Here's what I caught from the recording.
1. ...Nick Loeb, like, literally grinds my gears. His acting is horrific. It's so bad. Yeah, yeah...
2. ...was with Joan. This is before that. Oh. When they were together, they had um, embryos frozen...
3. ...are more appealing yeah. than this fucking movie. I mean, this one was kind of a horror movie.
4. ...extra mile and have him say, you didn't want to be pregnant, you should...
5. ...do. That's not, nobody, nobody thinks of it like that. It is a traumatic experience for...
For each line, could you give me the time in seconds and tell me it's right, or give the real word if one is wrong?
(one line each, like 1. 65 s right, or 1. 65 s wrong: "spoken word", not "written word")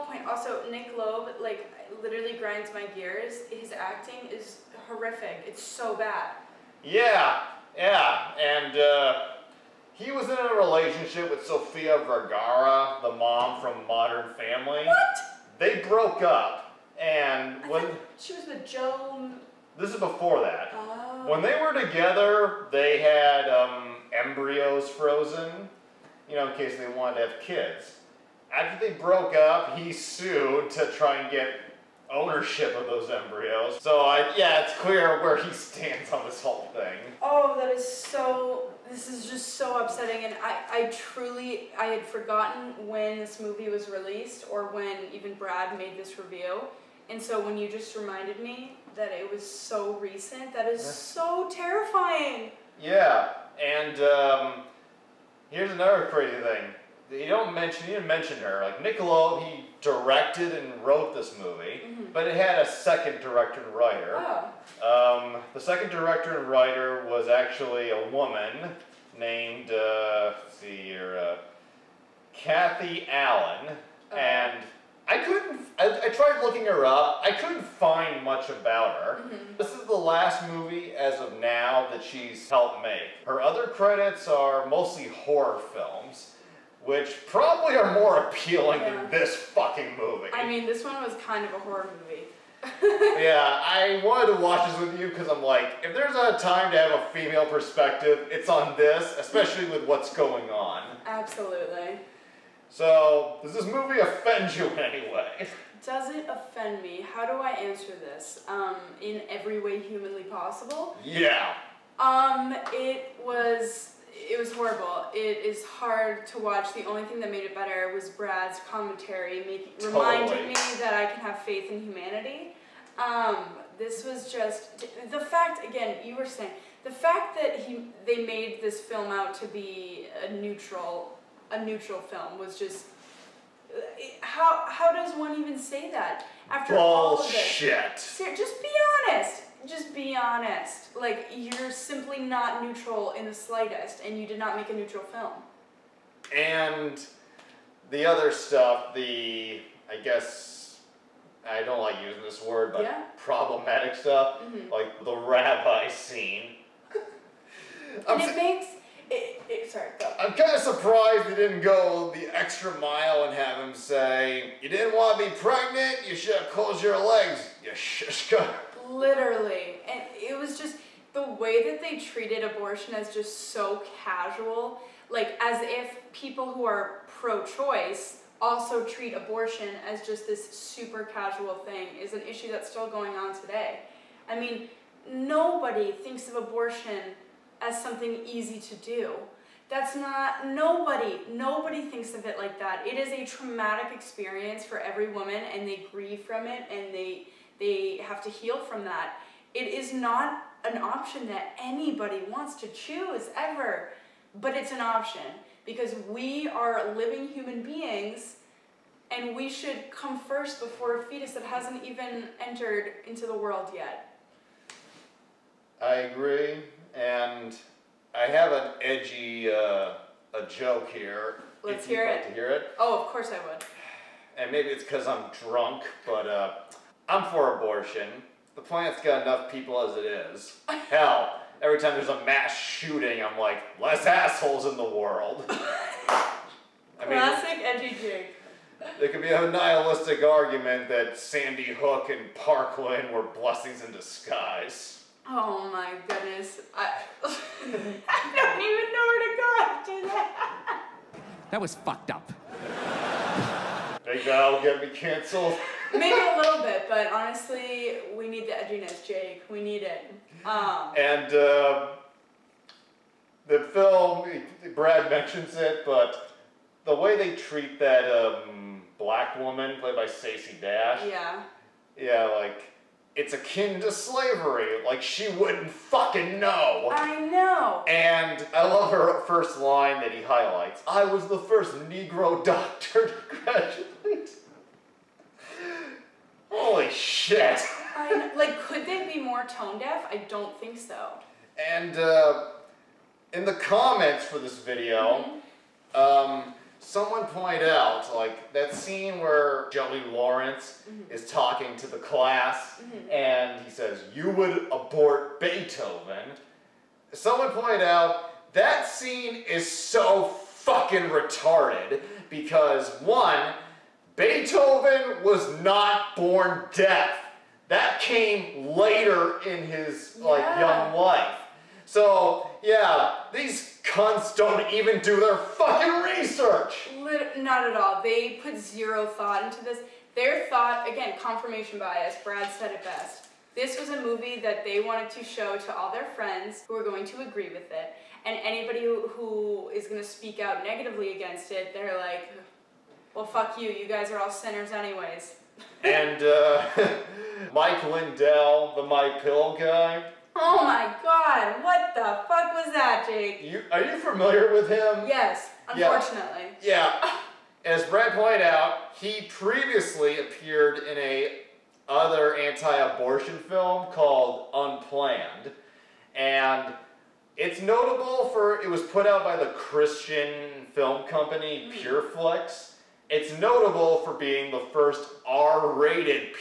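1. 0 s right
2. 18 s right
3. 87 s right
4. 162 s right
5. 188 s right.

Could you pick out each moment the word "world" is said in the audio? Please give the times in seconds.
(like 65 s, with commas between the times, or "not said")
213 s, 234 s.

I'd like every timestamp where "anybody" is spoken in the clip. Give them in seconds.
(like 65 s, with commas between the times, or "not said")
201 s, 338 s.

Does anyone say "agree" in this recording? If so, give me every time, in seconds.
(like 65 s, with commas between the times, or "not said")
216 s, 337 s.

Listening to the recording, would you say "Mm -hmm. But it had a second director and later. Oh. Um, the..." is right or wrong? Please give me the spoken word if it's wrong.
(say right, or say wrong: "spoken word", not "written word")
wrong: "writer", not "later".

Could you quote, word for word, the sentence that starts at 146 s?
And the other stuff, the, I guess, I don't like using this word, but yeah.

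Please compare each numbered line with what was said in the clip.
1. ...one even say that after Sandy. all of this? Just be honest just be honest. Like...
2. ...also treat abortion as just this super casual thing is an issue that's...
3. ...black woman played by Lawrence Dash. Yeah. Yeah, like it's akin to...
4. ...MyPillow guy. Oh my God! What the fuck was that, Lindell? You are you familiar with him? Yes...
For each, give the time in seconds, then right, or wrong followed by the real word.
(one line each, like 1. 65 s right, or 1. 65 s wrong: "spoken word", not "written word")
1. 135 s wrong: "Bullshit", not "Sandy"
2. 178 s right
3. 268 s wrong: "Stacey", not "Lawrence"
4. 348 s wrong: "Jake", not "Lindell".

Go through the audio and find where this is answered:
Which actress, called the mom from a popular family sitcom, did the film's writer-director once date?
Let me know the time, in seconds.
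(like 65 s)
11 s.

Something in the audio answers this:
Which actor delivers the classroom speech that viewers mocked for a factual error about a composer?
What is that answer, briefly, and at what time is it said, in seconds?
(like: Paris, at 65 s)
Joey Lawrence, at 299 s.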